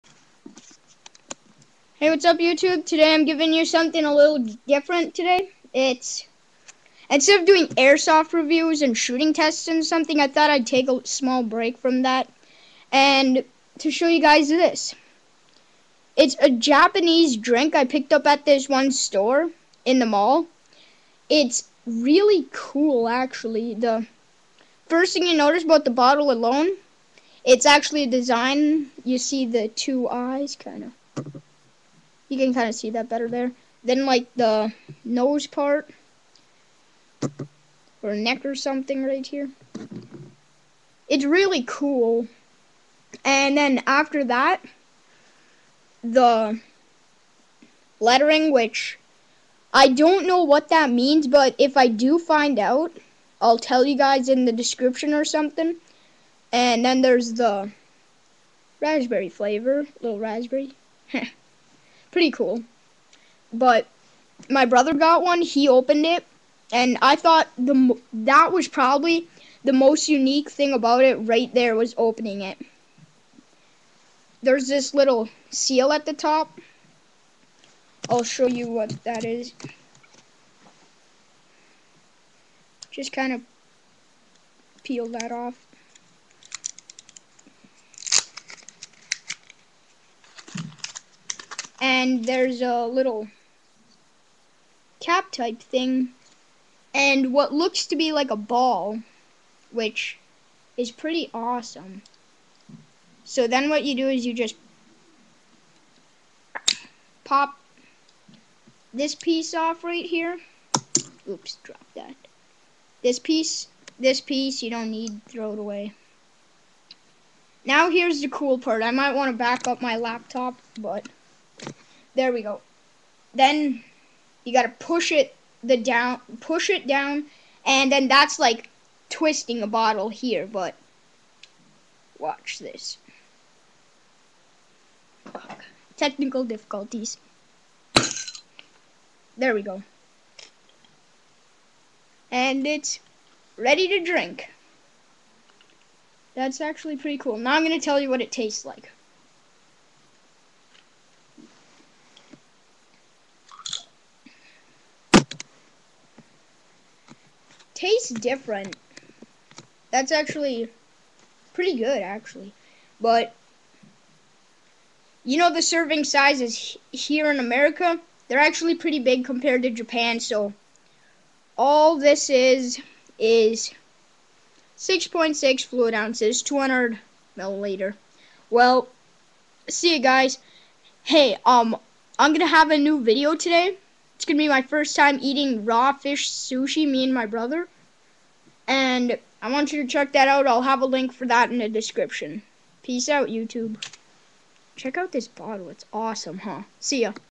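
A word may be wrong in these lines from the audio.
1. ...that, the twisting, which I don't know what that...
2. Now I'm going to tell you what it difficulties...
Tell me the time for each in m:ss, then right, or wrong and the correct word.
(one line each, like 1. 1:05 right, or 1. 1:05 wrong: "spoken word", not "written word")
1. 0:44 wrong: "lettering", not "twisting"
2. 2:27 wrong: "tastes", not "difficulties".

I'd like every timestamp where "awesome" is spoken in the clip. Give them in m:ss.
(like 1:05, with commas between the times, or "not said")
1:41, 3:15.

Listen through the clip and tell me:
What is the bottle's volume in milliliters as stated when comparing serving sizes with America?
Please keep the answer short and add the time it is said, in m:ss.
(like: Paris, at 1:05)
200, at 2:56.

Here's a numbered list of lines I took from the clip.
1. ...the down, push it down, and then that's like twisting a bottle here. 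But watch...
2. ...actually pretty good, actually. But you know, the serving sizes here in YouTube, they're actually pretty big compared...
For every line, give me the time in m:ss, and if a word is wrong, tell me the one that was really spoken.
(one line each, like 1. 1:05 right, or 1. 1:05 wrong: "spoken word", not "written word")
1. 2:05 right
2. 2:40 wrong: "America", not "YouTube".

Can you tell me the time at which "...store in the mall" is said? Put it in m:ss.
0:18.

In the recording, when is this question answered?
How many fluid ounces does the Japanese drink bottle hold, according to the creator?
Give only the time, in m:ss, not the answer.
2:54.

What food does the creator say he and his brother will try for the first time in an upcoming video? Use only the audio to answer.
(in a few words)
Raw fish sushi.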